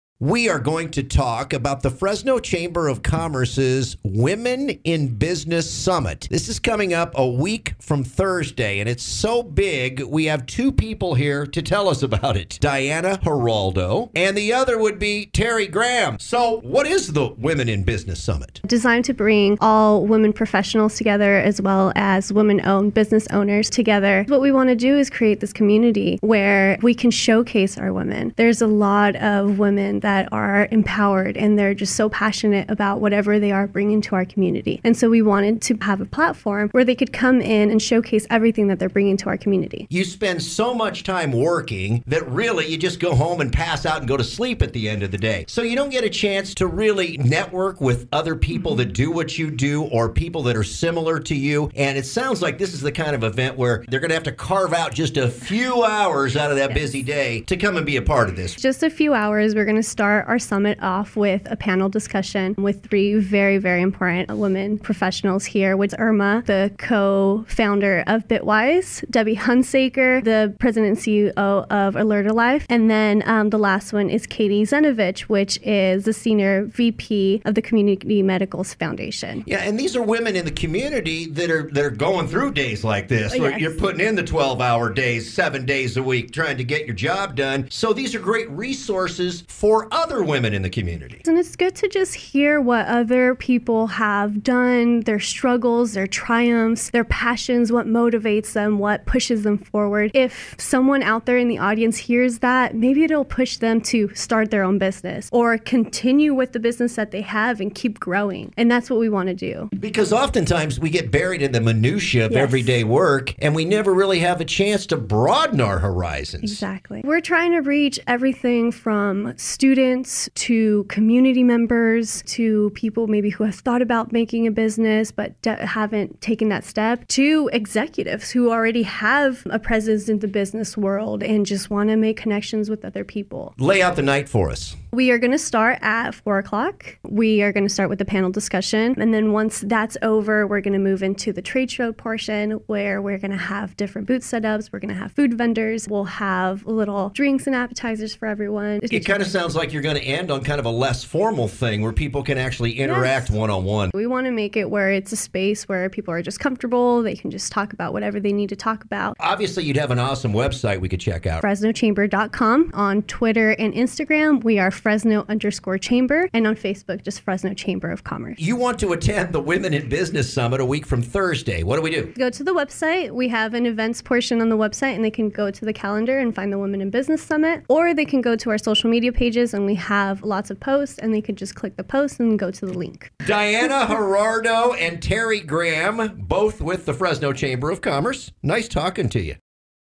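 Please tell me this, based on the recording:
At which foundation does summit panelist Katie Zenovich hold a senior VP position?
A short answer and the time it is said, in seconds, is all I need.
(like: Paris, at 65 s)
Community Medicals Foundation, at 77 s.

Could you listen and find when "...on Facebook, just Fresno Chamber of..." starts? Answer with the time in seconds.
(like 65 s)
166 s.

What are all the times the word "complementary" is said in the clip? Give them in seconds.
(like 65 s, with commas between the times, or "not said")
not said.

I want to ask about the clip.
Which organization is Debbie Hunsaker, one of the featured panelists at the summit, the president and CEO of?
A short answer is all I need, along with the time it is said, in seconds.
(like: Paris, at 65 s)
Alert-O-Lab, at 71 s.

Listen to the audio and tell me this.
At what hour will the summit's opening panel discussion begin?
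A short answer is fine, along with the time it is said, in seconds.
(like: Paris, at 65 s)
4 o'clock, at 136 s.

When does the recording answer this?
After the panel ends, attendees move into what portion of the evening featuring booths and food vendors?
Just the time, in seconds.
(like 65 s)
141 s.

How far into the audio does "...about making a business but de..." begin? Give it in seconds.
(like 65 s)
123 s.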